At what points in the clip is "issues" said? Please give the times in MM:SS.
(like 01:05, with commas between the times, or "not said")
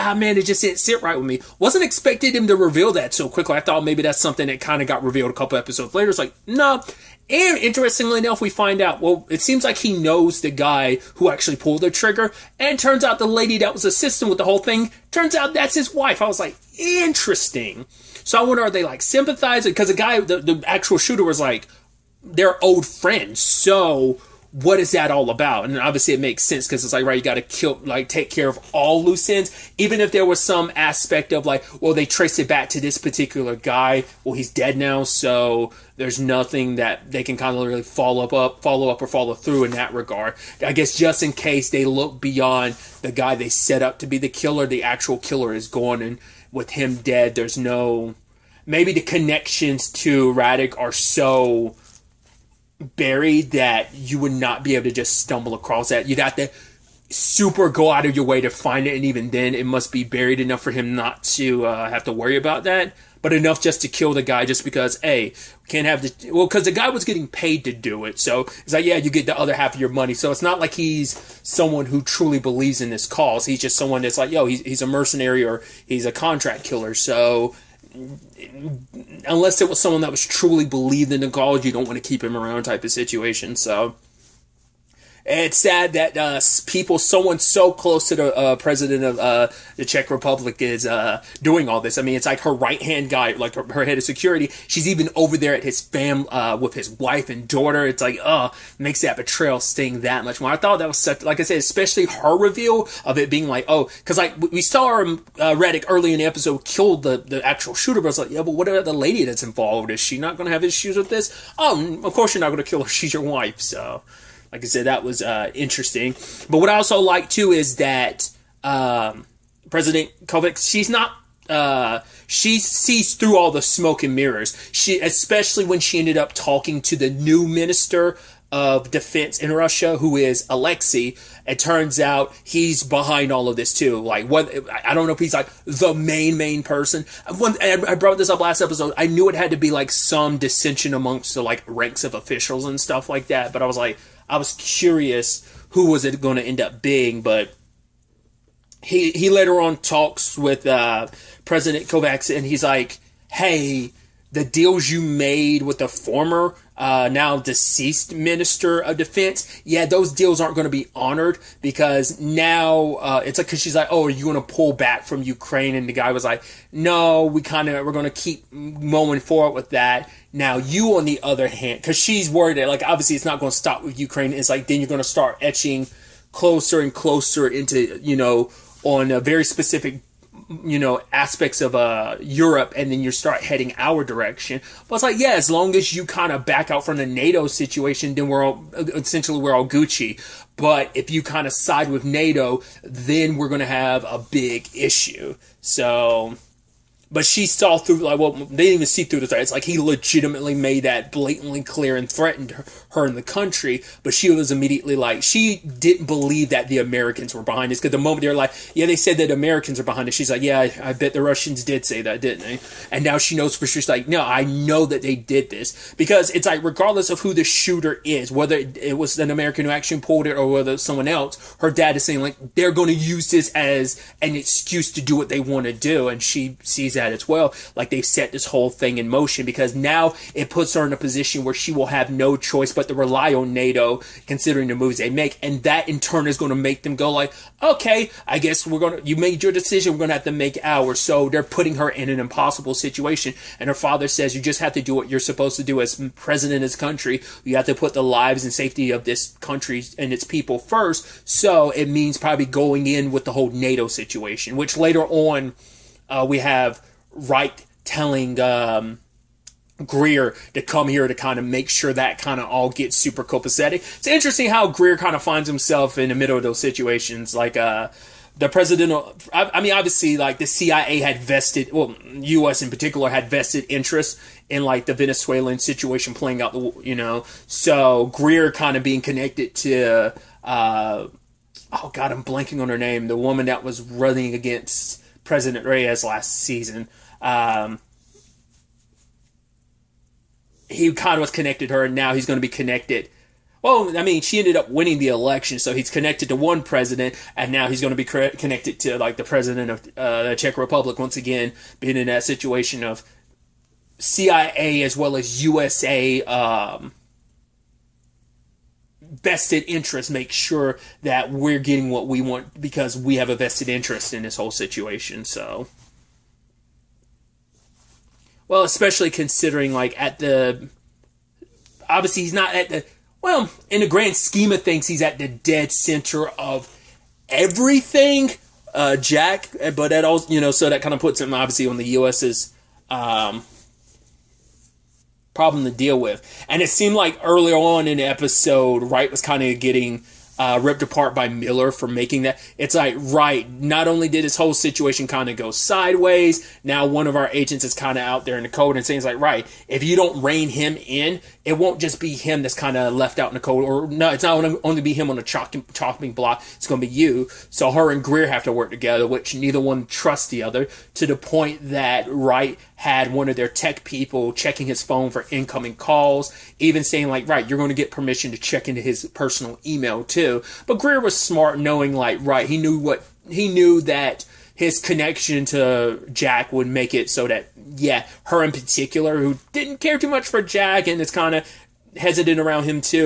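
01:50, 03:14.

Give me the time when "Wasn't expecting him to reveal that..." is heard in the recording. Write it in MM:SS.
00:01.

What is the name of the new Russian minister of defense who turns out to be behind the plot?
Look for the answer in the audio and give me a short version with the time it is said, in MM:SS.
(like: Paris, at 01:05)
Alexei, at 02:10.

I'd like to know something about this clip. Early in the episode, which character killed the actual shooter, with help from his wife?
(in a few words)
Reddick.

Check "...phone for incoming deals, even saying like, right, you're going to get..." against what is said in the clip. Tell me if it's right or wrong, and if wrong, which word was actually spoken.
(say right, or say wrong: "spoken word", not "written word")
wrong: "calls", not "deals".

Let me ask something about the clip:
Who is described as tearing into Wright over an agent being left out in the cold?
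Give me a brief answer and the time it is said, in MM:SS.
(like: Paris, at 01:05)
Miller, at 05:41.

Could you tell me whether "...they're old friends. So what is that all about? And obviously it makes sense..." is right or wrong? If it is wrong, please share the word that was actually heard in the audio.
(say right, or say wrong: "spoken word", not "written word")
right.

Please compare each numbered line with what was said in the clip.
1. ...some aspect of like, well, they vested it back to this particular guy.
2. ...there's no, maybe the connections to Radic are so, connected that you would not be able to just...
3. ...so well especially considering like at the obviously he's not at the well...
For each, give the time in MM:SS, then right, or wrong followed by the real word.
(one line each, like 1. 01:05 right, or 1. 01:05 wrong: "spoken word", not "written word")
1. 00:30 wrong: "traced", not "vested"
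2. 00:47 wrong: "buried", not "connected"
3. 05:15 right.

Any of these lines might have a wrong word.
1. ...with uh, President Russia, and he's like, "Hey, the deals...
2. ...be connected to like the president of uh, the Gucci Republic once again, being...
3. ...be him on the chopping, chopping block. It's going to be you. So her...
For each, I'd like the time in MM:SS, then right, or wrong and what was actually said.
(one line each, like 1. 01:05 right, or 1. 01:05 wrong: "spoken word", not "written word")
1. 02:30 wrong: "Kovacs", not "Russia"
2. 04:57 wrong: "Czech", not "Gucci"
3. 05:54 right.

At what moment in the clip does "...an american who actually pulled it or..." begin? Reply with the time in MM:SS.
03:39.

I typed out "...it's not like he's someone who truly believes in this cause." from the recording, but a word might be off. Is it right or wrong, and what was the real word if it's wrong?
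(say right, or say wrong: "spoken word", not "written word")
right.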